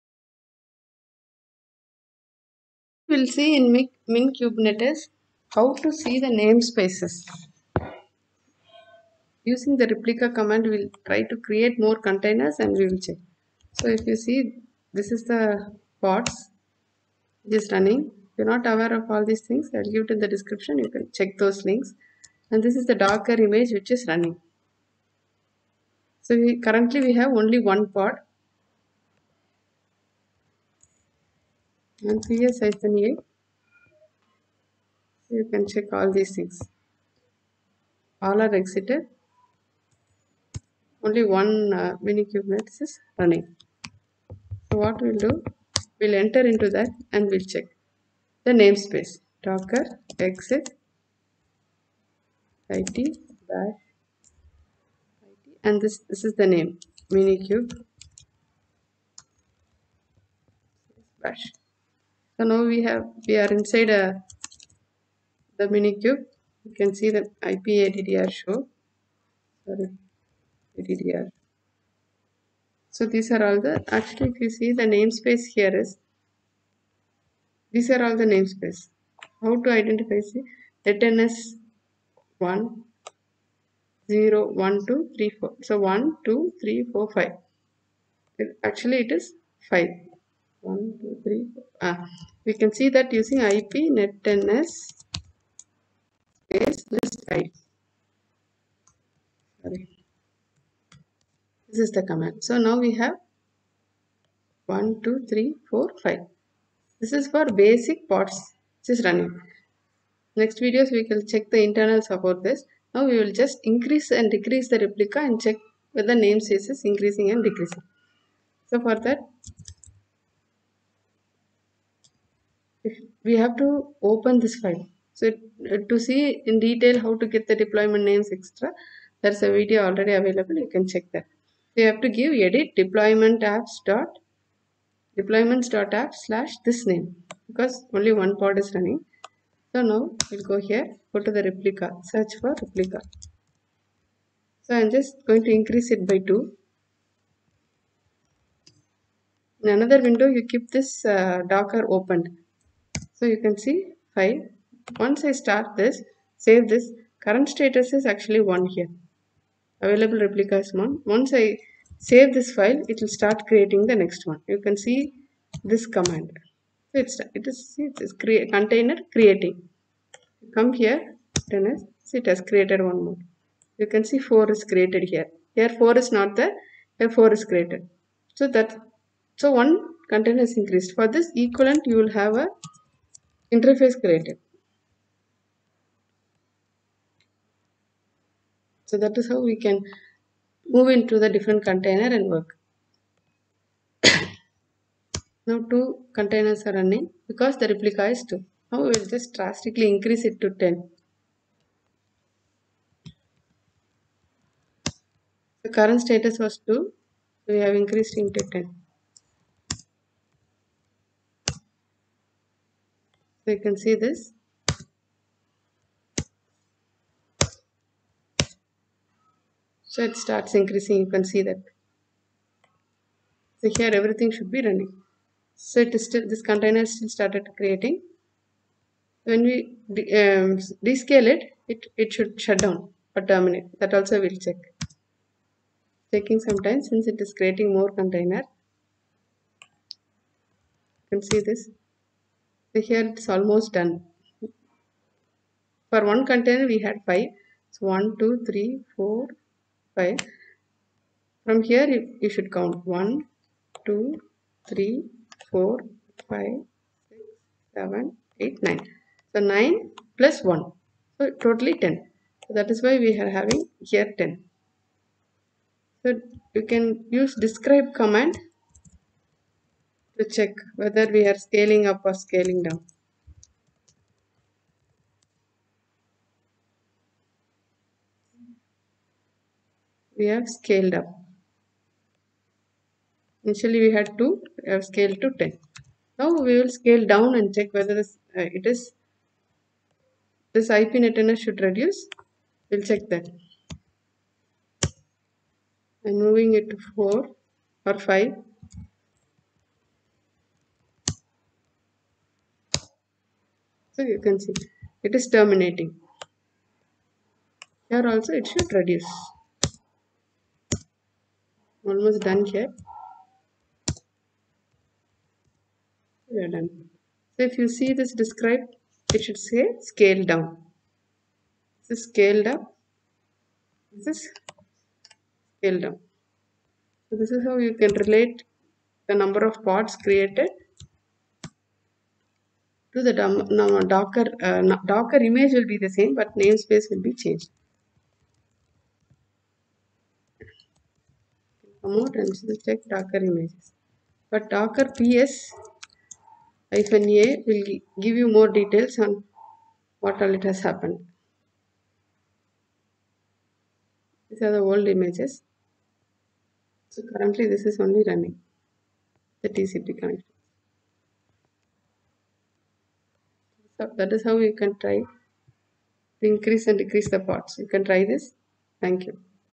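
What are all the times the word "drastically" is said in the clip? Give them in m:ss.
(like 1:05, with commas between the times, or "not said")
3:19.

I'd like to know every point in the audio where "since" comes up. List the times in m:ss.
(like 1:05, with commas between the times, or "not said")
3:56.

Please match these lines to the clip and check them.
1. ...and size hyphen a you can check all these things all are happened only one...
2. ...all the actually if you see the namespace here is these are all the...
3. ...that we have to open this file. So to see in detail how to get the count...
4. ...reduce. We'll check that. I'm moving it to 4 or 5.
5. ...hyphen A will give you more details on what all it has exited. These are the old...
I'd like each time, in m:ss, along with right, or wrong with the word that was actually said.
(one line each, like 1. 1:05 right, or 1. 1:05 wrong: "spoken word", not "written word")
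1. 0:32 wrong: "exited", not "happened"
2. 1:13 right
3. 1:59 wrong: "deployment", not "count"
4. 4:51 right
5. 5:46 wrong: "happened", not "exited".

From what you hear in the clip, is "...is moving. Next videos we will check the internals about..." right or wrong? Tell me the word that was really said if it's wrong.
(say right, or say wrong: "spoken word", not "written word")
wrong: "running", not "moving".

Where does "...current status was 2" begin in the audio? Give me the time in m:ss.
3:25.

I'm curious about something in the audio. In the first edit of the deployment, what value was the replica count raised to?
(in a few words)
2.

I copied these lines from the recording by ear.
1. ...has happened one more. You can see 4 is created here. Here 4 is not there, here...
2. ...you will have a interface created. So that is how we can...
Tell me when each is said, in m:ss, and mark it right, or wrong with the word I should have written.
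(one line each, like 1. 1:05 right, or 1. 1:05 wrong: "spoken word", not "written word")
1. 2:52 wrong: "created", not "happened"
2. 3:01 right.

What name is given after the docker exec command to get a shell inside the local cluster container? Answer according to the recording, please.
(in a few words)
minikube.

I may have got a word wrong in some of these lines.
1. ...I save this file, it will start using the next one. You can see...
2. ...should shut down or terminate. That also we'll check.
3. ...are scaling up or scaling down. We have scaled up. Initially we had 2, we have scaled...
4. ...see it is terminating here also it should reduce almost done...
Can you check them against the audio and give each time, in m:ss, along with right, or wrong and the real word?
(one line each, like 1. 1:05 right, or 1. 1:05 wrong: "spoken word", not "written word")
1. 2:41 wrong: "creating", not "using"
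2. 3:52 right
3. 4:31 right
4. 5:04 right.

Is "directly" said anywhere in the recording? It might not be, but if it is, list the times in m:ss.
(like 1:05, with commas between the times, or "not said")
not said.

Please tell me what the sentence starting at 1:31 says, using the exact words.
ah we can see that using IP net netns space list i.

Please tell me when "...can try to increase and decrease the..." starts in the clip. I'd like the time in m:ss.
6:04.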